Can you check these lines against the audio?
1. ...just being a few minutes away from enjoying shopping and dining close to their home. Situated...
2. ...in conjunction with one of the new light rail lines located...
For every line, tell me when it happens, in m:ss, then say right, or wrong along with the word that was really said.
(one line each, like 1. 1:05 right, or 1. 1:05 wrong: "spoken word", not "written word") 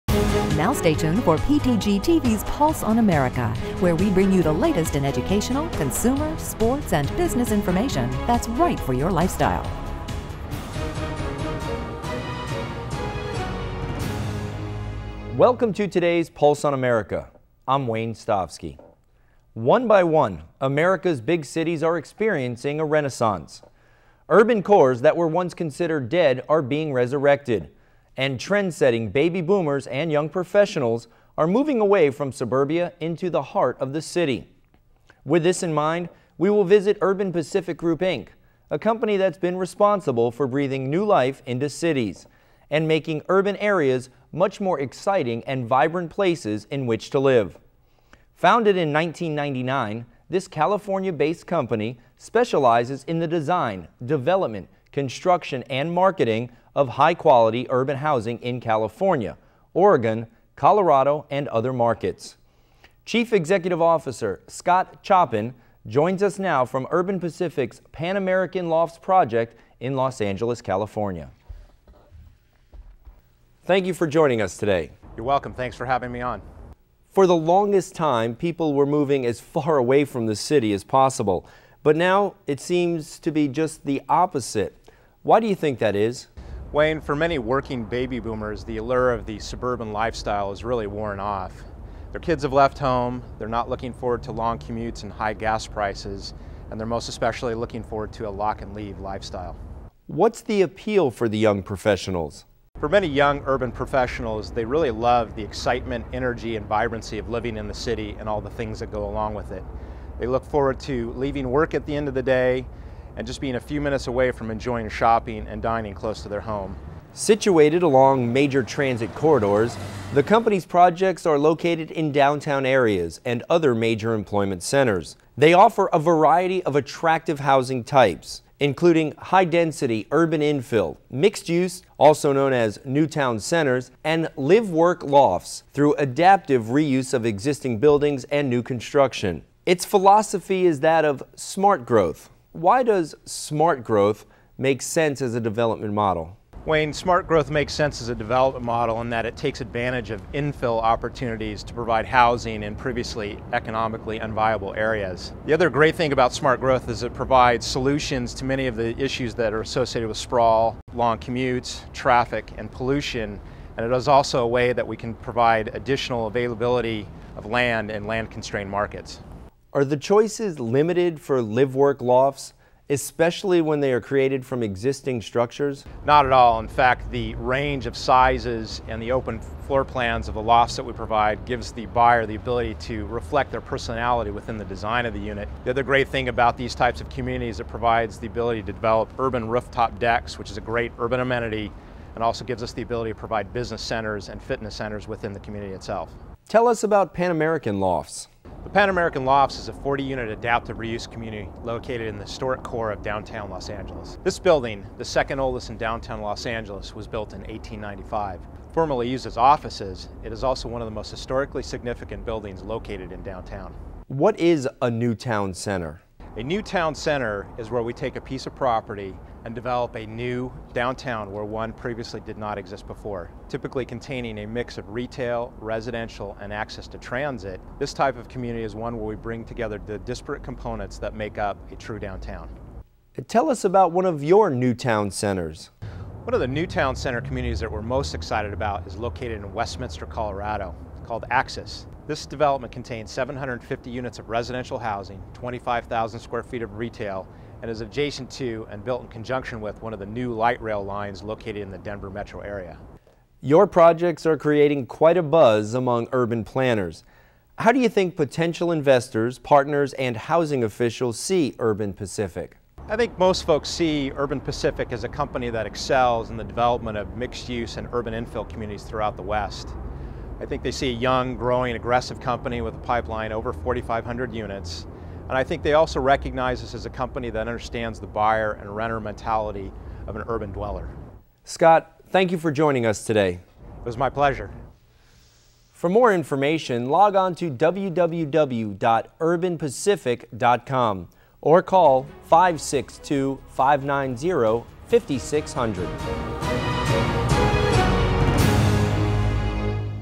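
1. 1:53 right
2. 4:09 right.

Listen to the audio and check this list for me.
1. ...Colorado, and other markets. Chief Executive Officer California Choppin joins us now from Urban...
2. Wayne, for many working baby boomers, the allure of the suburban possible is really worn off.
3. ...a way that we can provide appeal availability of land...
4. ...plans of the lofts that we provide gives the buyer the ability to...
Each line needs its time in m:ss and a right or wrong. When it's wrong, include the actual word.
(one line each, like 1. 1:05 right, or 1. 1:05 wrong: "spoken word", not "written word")
1. 1:00 wrong: "Scott", not "California"
2. 1:26 wrong: "lifestyle", not "possible"
3. 2:44 wrong: "additional", not "appeal"
4. 2:59 right.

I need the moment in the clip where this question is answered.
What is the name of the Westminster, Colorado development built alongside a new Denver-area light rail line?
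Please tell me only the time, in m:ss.
4:01.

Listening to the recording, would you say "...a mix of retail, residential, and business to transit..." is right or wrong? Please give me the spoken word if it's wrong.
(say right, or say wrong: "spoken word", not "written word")
wrong: "access", not "business".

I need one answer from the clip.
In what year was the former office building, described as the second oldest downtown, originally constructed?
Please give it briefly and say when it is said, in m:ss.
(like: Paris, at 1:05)
1895, at 3:27.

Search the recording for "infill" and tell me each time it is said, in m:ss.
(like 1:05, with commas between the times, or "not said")
2:10, 2:30, 4:28.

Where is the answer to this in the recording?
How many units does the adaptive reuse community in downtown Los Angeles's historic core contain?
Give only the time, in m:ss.
3:19.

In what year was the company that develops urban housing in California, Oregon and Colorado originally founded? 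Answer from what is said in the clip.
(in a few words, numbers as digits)
1999.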